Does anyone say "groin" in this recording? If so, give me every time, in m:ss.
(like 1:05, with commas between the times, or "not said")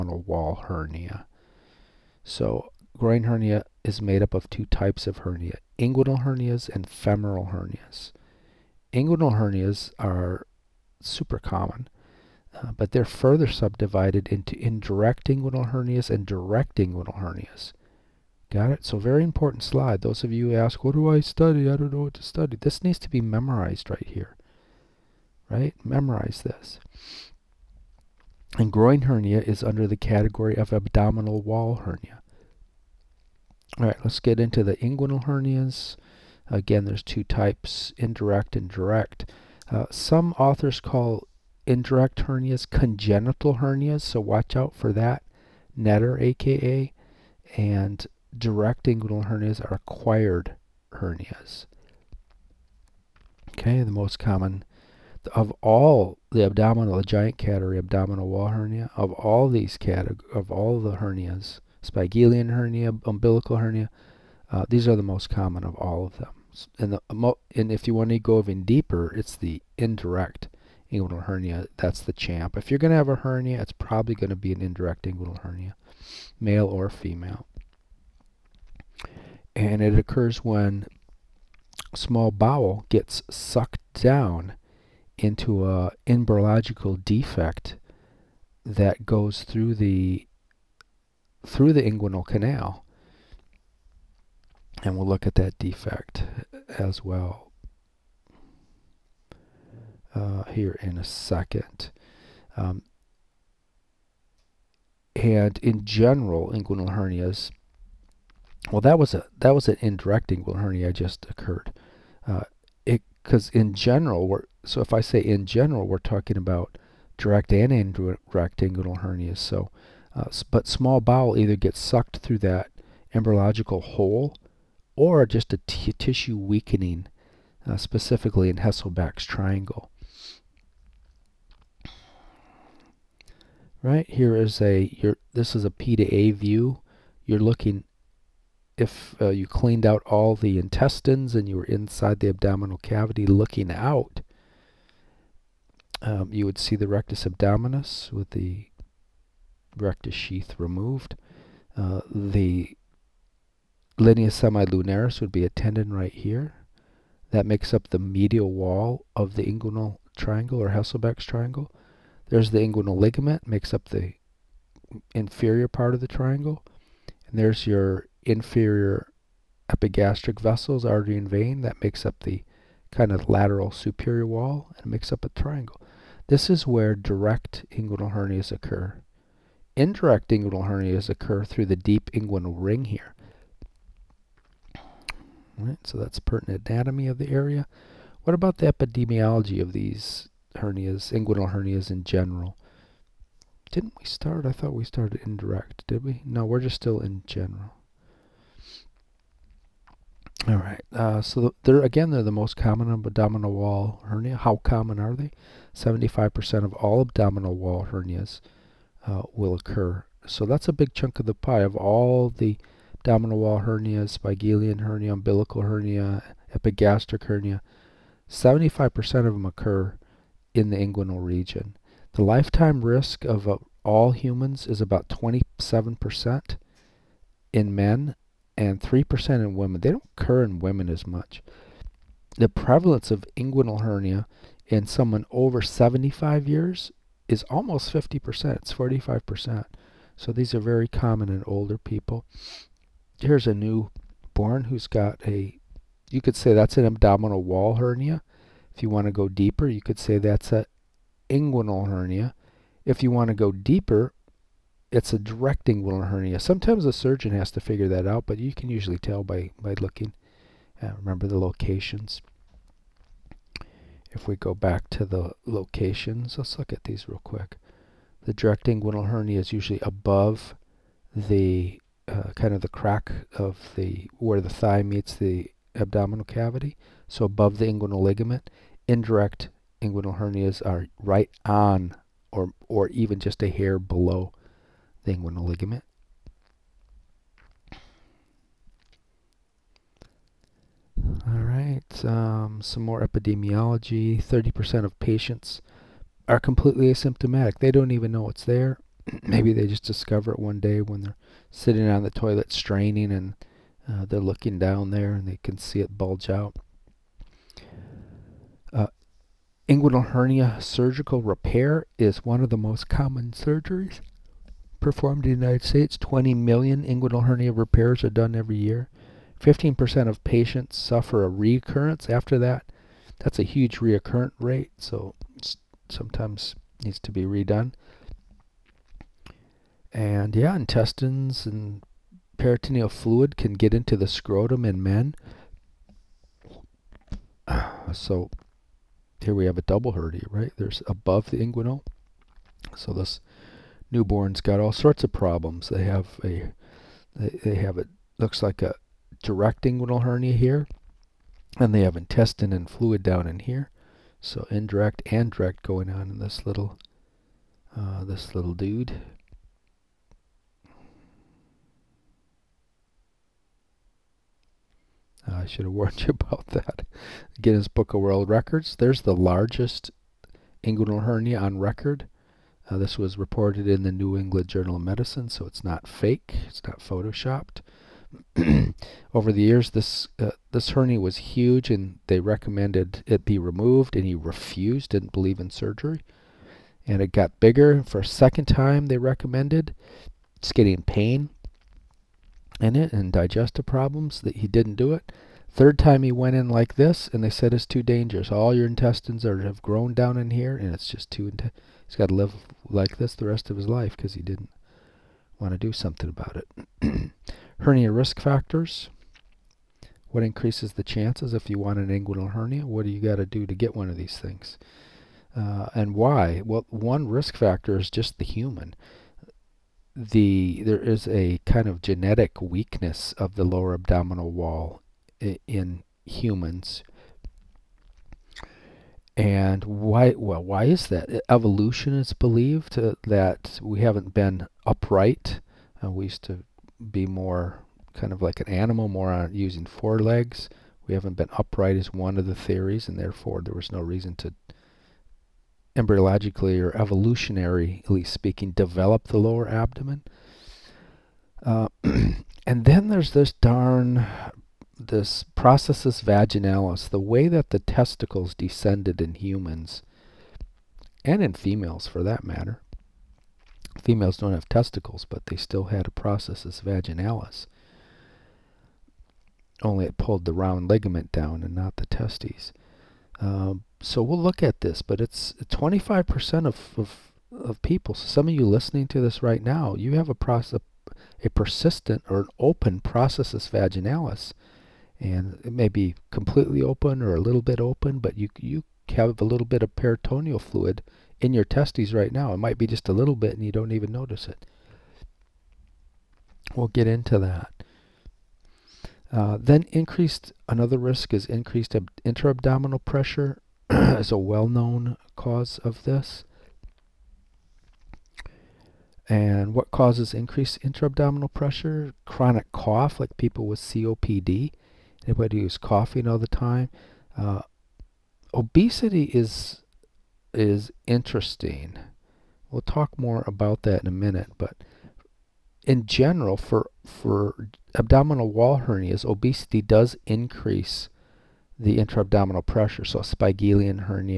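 0:02, 0:28.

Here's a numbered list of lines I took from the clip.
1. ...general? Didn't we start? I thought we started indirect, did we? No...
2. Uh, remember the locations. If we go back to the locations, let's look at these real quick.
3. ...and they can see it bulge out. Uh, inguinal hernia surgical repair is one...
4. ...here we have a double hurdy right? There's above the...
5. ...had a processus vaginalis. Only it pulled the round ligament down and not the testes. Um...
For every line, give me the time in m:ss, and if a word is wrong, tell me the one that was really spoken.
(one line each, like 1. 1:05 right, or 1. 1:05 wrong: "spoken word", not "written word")
1. 3:12 right
2. 4:20 right
3. 5:05 right
4. 5:39 right
5. 7:45 right.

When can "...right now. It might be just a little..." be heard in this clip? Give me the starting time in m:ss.
8:11.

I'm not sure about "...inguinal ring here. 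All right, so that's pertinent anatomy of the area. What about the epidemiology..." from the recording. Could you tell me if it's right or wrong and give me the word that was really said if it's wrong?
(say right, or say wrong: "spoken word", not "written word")
right.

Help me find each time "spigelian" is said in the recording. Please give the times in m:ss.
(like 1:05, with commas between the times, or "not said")
1:01, 3:34, 8:53.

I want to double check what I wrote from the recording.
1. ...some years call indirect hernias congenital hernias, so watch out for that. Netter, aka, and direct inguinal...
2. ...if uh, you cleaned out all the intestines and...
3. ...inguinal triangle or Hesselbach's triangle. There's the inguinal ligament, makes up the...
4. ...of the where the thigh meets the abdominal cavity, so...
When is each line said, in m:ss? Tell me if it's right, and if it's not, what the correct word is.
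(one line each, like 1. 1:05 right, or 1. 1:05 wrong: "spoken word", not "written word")
1. 0:39 wrong: "authors", not "years"
2. 2:18 right
3. 2:39 right
4. 4:33 right.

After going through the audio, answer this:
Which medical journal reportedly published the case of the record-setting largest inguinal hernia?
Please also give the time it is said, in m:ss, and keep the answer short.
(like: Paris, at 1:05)
New England Journal of Medicine, at 6:13.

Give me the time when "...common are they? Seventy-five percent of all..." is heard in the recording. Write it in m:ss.
3:24.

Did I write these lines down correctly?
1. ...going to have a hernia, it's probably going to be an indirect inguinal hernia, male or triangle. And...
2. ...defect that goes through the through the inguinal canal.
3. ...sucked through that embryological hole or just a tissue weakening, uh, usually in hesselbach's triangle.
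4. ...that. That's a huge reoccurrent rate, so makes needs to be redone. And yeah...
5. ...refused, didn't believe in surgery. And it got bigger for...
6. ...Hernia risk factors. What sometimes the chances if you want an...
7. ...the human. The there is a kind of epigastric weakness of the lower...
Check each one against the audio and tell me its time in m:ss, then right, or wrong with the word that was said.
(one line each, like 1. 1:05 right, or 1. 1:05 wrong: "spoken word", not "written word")
1. 1:12 wrong: "female", not "triangle"
2. 1:26 right
3. 2:01 wrong: "specifically", not "usually"
4. 5:22 wrong: "sometimes", not "makes"
5. 6:24 right
6. 6:47 wrong: "increases", not "sometimes"
7. 6:58 wrong: "genetic", not "epigastric".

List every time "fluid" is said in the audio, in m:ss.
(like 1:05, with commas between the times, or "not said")
5:32, 5:52, 8:10.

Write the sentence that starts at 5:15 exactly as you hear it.
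20 million inguinal hernia repairs are done every year.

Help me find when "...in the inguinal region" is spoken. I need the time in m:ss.
3:40.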